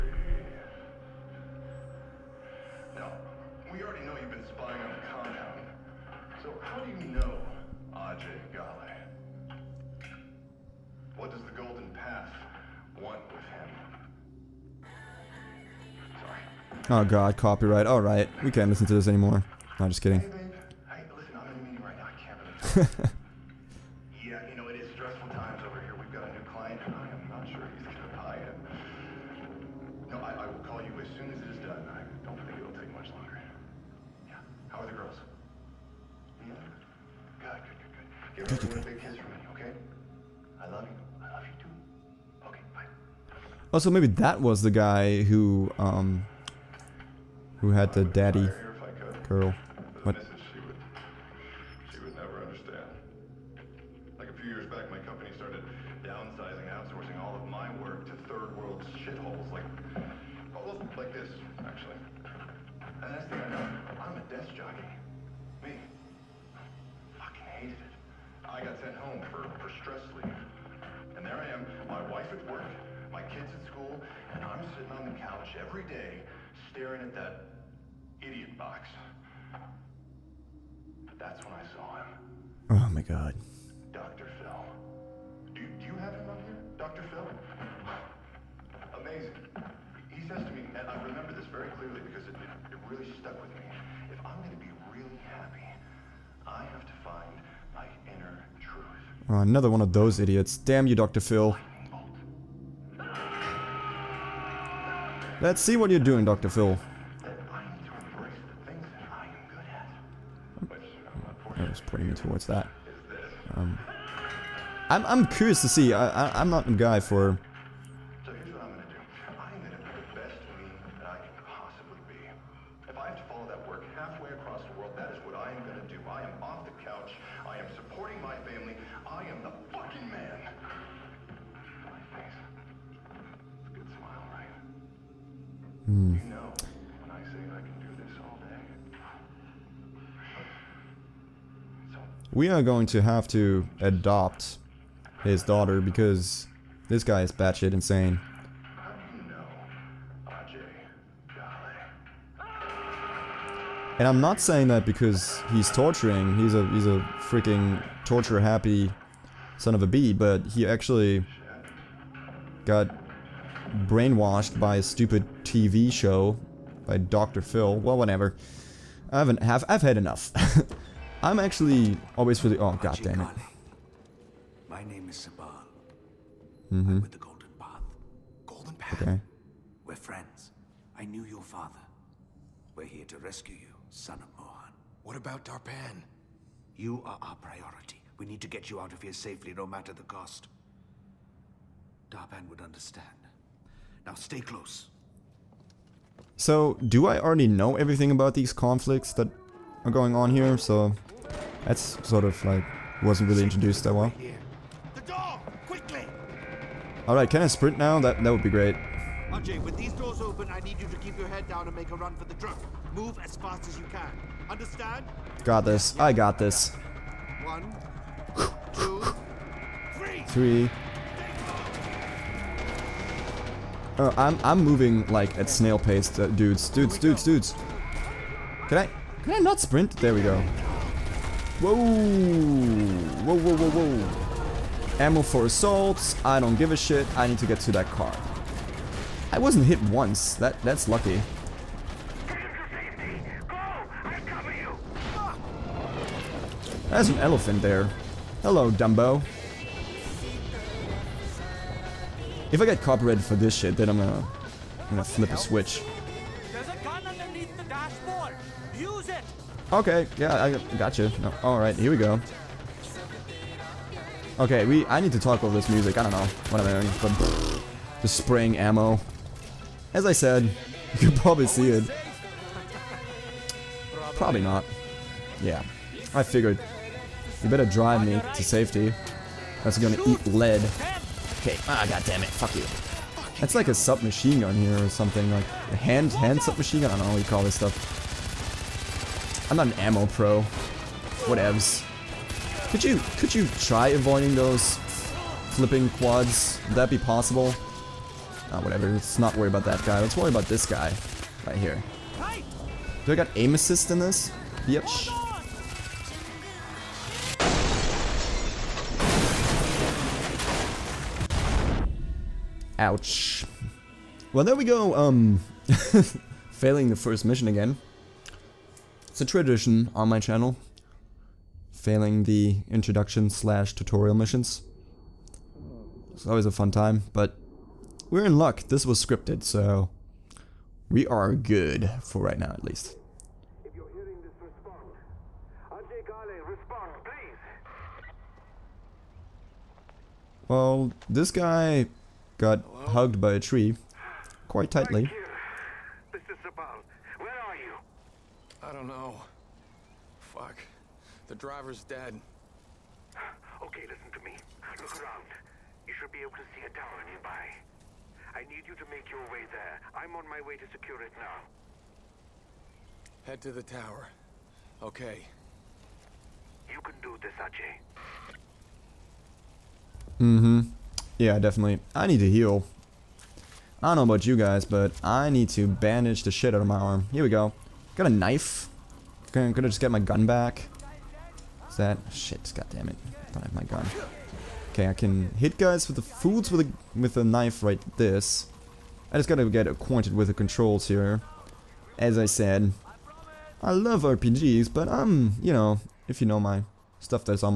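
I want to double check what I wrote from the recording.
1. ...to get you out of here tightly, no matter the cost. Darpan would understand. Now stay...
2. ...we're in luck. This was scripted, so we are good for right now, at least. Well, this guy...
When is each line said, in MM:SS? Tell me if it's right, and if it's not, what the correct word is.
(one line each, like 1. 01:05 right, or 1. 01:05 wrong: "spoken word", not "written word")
1. 03:08 wrong: "safely", not "tightly"
2. 05:28 right.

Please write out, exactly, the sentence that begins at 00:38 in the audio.
Give everyone a big kiss from me, okay?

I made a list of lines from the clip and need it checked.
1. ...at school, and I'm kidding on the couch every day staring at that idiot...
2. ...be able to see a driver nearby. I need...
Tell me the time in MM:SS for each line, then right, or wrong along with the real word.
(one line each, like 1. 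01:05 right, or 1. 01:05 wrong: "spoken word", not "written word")
1. 01:13 wrong: "sitting", not "kidding"
2. 05:56 wrong: "tower", not "driver".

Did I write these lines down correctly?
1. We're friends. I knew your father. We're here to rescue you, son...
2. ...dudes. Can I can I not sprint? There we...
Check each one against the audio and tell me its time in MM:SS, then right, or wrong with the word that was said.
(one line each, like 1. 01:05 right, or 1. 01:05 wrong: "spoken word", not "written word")
1. 02:59 right
2. 03:47 right.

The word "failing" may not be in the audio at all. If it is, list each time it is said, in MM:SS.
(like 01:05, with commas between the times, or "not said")
05:16, 05:21.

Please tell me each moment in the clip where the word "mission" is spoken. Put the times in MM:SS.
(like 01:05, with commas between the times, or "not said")
05:17, 05:24.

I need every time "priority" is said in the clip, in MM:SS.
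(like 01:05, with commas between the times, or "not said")
03:07.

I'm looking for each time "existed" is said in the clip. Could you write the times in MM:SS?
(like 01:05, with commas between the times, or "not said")
not said.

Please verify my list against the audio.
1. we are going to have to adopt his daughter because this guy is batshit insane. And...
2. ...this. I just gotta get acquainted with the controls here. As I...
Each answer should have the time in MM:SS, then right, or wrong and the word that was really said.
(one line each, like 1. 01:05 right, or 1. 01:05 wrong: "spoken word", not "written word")
1. 02:22 right
2. 06:27 right.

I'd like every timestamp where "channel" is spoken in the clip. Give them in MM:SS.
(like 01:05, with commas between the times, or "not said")
05:20.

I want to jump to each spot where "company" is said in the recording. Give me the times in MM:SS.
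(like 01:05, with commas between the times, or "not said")
00:55.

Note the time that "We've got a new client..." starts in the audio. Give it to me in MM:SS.
00:25.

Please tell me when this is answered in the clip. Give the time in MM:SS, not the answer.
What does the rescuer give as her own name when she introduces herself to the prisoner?
02:55.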